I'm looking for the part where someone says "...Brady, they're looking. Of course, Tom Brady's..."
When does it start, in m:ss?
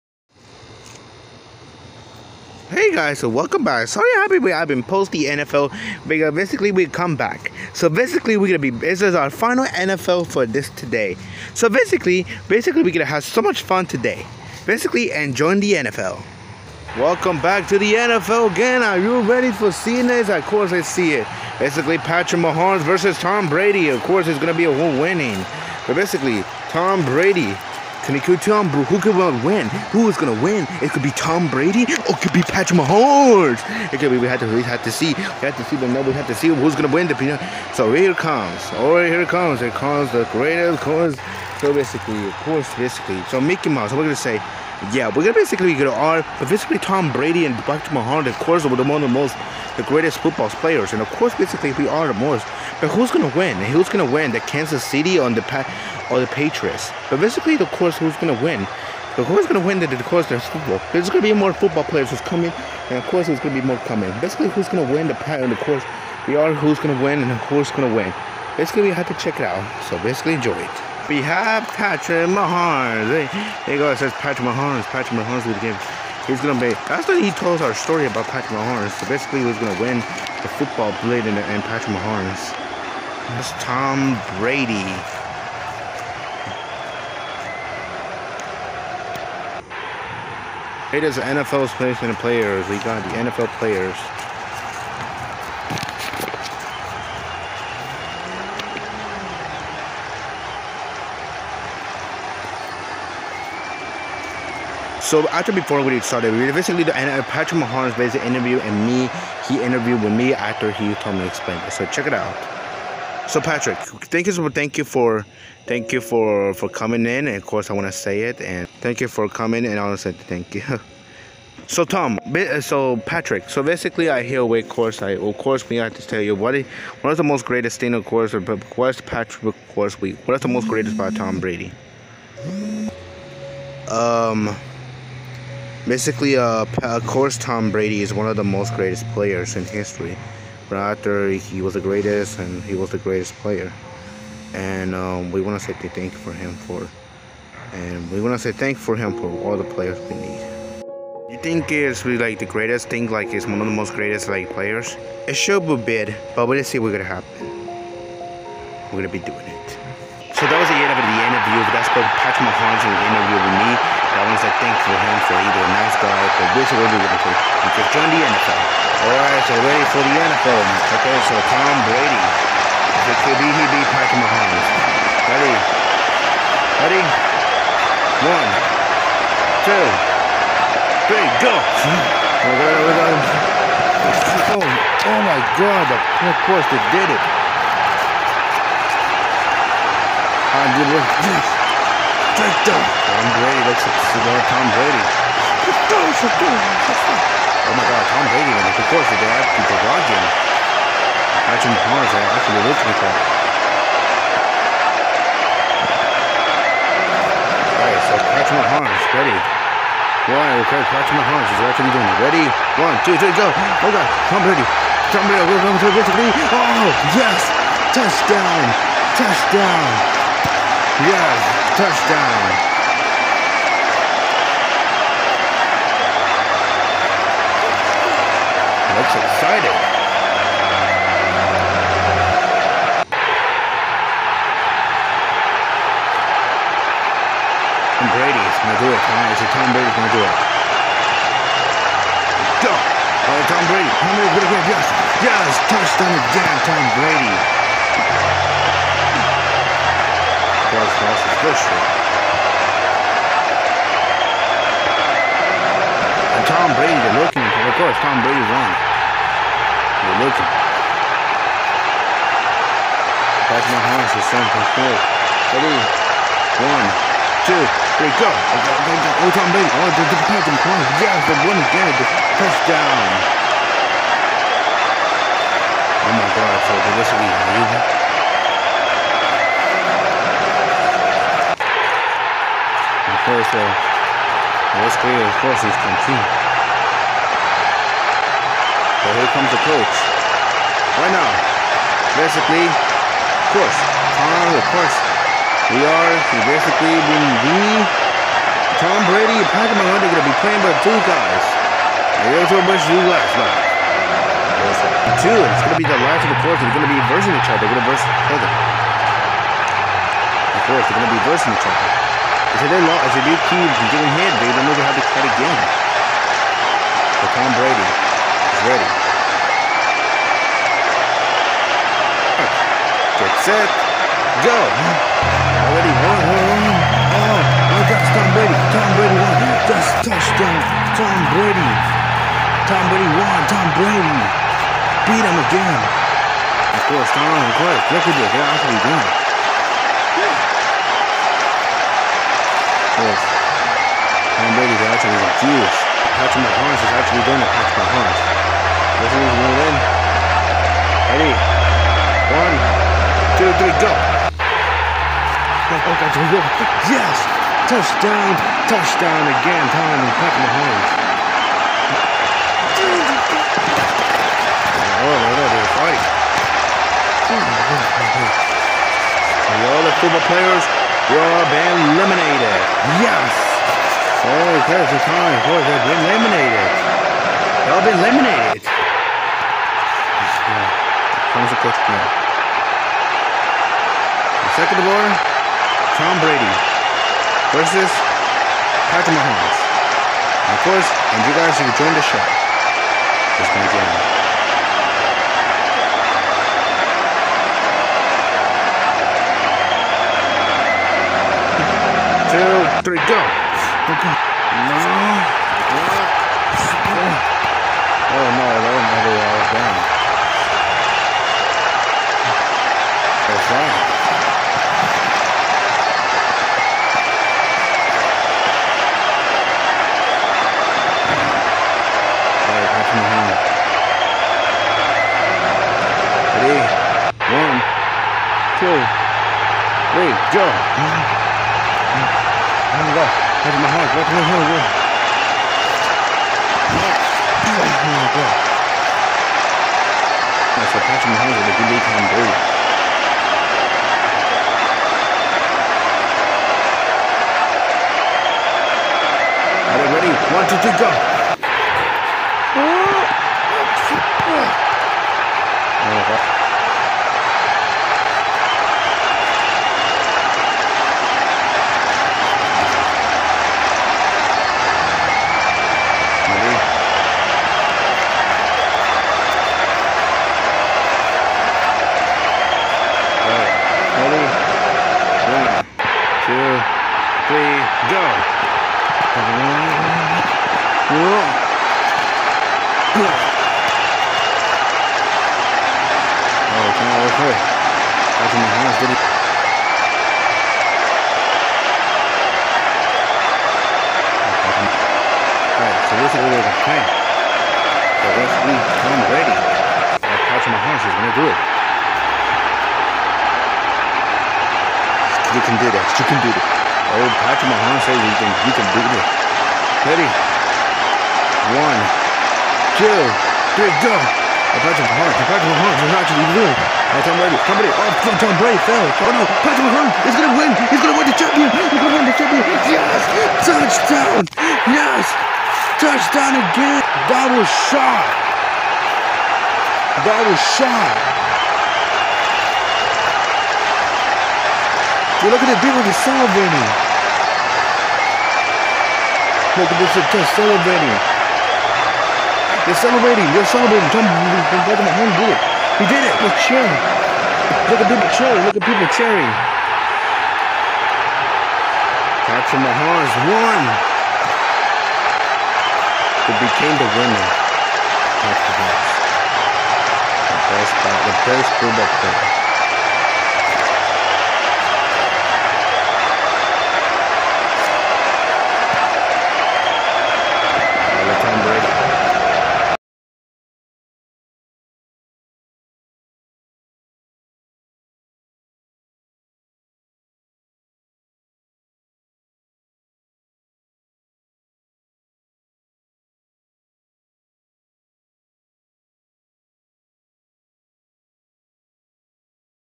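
4:16.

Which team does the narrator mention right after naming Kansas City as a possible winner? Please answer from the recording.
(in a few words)
Patriots.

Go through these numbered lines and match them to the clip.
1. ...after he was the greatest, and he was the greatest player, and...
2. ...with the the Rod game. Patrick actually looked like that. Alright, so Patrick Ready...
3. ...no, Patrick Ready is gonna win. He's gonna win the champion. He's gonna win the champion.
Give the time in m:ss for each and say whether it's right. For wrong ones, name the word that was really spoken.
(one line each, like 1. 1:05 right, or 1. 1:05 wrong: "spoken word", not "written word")
1. 2:20 right
2. 3:19 wrong: "Mahomes", not "Ready"
3. 8:39 wrong: "Mahomes", not "Ready".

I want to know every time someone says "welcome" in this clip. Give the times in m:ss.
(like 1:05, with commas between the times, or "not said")
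0:03, 0:16.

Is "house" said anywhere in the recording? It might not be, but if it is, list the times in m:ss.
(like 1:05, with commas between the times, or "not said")
4:23, 8:08.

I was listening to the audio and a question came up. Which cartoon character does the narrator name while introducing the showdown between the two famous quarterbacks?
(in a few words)
Mickey Mouse.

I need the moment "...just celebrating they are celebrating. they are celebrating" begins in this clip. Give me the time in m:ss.
9:00.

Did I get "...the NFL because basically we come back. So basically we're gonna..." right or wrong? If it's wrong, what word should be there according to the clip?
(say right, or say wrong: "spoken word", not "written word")
right.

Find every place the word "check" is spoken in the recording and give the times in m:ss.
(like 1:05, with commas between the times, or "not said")
1:09, 1:51.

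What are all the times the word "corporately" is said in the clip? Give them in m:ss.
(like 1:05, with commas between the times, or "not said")
not said.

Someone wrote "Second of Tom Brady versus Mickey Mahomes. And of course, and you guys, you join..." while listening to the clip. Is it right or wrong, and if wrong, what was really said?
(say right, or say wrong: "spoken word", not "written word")
wrong: "Patrick", not "Mickey".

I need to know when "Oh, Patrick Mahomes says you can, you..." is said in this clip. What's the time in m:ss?
8:26.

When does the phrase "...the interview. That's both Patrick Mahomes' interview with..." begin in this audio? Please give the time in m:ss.
2:41.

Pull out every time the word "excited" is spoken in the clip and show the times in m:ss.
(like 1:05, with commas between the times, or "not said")
3:49.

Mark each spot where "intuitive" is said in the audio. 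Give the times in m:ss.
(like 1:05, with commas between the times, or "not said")
not said.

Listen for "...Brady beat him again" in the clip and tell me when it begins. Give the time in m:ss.
5:33.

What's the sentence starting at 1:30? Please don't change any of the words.
It is the NFL's placement of players.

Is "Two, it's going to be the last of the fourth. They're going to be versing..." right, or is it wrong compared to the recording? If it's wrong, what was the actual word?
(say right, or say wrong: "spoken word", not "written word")
right.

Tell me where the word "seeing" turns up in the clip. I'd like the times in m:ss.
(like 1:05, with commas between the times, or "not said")
0:19.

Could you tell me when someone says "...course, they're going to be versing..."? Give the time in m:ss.
5:10.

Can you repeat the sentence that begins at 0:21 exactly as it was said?
Basically, Patrick Mahomes versus Tom Brady.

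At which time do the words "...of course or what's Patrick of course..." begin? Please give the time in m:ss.
2:07.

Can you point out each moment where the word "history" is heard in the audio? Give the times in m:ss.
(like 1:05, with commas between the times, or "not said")
2:19, 4:11.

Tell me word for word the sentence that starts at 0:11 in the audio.
So basically, basically we're gonna have so much fun today.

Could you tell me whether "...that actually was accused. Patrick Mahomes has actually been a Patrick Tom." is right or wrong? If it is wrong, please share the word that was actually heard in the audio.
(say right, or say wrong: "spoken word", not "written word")
wrong: "Mahomes", not "Tom".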